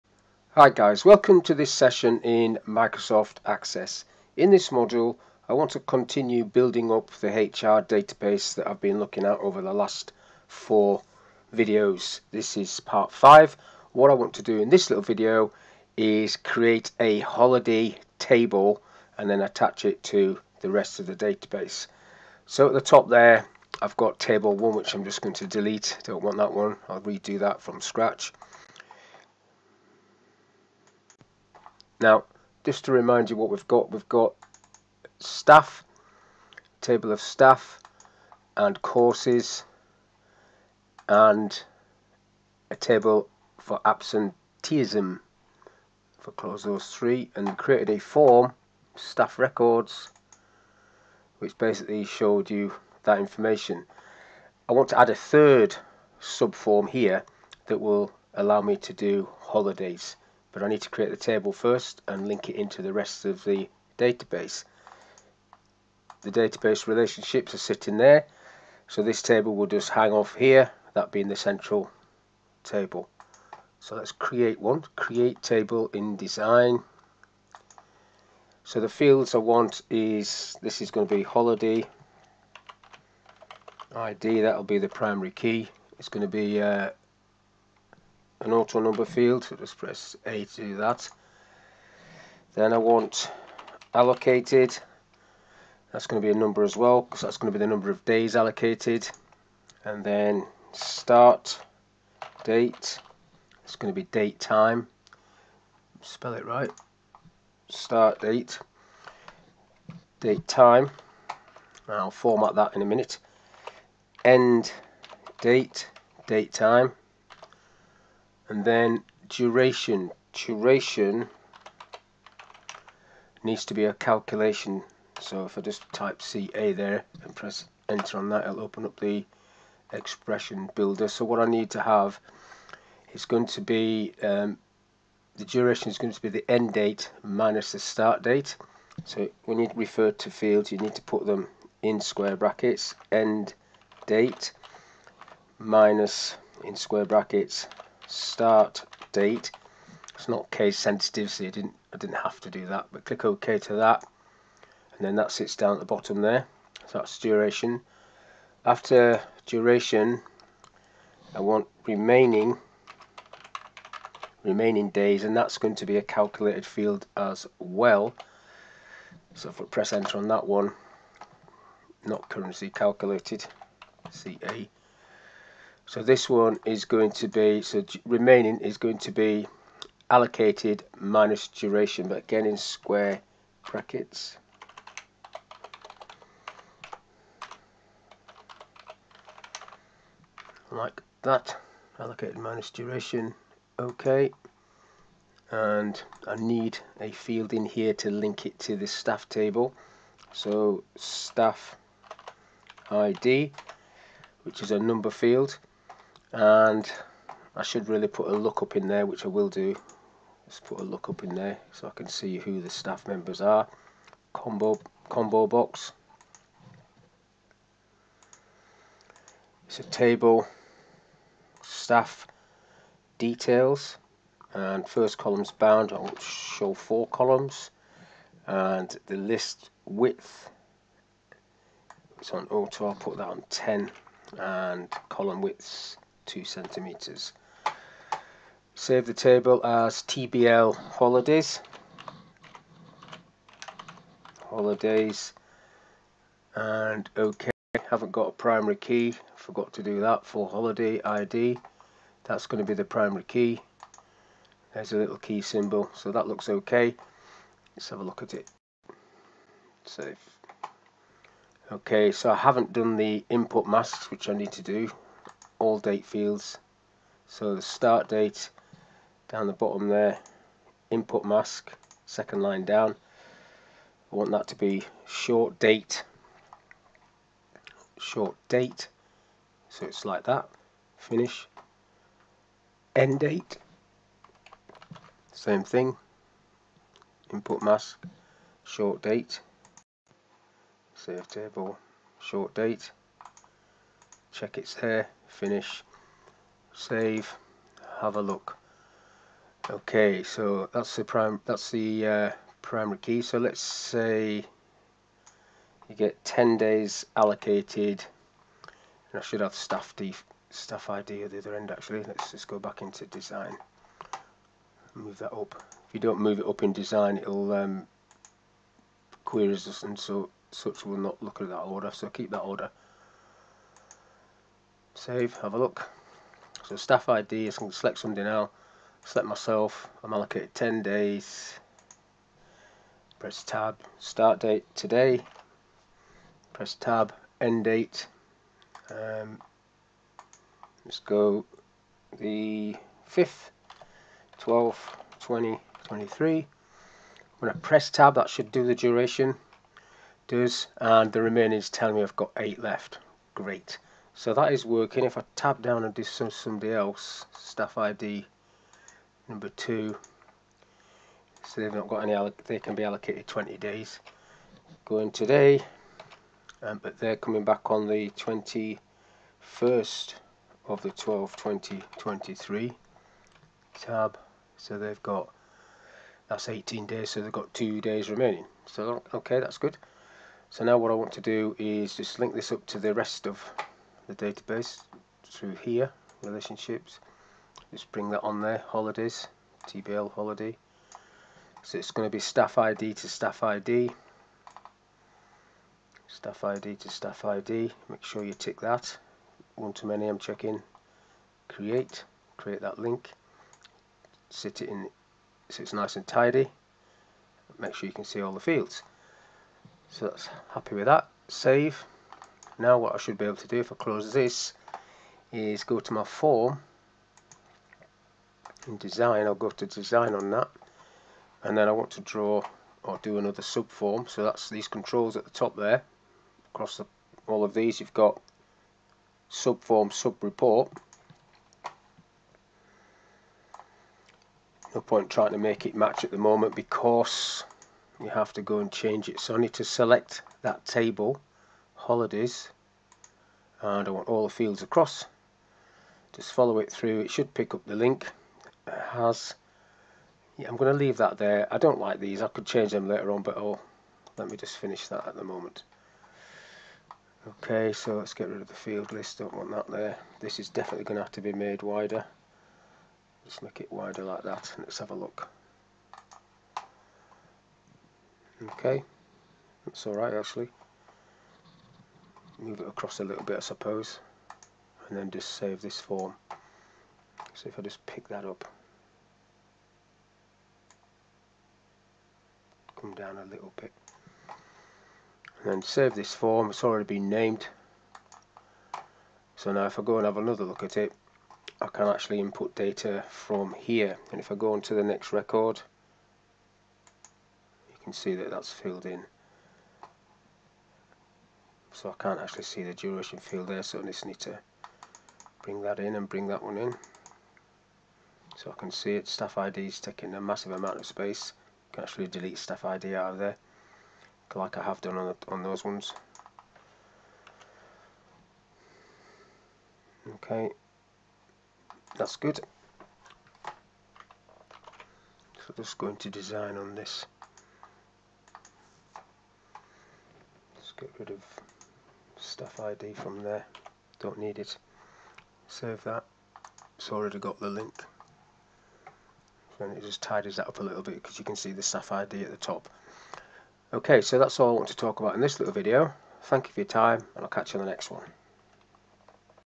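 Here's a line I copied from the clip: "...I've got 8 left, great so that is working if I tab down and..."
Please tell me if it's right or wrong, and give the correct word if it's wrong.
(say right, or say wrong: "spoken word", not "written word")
right.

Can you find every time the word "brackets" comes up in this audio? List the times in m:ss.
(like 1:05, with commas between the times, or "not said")
2:22, 2:27, 3:03.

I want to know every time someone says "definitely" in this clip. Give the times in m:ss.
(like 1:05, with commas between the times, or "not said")
7:40.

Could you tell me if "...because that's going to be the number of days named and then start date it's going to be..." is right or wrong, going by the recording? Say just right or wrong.
wrong.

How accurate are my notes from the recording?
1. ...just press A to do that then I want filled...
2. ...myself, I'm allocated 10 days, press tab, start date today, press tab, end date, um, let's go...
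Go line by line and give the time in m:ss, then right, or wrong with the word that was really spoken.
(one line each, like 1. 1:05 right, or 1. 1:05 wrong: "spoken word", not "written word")
1. 1:29 wrong: "allocated", not "filled"
2. 5:29 right.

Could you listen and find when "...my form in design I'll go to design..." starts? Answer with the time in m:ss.
6:55.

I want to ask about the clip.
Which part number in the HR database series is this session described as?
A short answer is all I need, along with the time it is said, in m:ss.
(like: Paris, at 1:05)
Part 5, at 0:12.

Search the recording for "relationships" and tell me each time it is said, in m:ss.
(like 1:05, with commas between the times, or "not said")
1:06, 6:26.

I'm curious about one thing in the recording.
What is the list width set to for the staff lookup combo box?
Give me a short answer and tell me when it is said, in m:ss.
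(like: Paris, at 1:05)
10, at 3:52.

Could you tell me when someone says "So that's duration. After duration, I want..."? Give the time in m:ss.
2:36.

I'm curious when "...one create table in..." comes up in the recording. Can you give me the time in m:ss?
1:14.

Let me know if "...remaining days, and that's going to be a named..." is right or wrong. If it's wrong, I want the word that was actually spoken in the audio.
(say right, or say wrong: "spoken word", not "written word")
wrong: "calculated", not "named".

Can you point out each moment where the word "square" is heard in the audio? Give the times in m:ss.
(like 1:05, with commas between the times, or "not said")
2:22, 2:26, 3:02.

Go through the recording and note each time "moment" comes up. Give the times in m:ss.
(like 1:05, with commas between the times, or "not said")
7:16, 7:35.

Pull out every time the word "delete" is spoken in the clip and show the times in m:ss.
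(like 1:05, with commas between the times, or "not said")
0:25, 8:32.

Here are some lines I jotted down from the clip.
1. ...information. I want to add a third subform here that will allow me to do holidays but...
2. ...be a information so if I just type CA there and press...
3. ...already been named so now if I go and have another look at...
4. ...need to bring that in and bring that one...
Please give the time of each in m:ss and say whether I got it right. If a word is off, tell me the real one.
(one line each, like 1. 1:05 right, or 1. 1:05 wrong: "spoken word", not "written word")
1. 0:53 right
2. 2:03 wrong: "calculation", not "information"
3. 8:06 right
4. 8:24 right.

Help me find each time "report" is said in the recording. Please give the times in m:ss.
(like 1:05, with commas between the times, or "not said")
7:10.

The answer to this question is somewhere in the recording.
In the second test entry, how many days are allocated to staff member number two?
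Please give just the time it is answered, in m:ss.
6:03.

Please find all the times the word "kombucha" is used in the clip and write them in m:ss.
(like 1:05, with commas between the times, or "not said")
not said.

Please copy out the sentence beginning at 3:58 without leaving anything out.
Save the table as TBL holidays.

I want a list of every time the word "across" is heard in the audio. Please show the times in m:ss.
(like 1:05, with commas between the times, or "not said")
7:06, 7:24, 7:52.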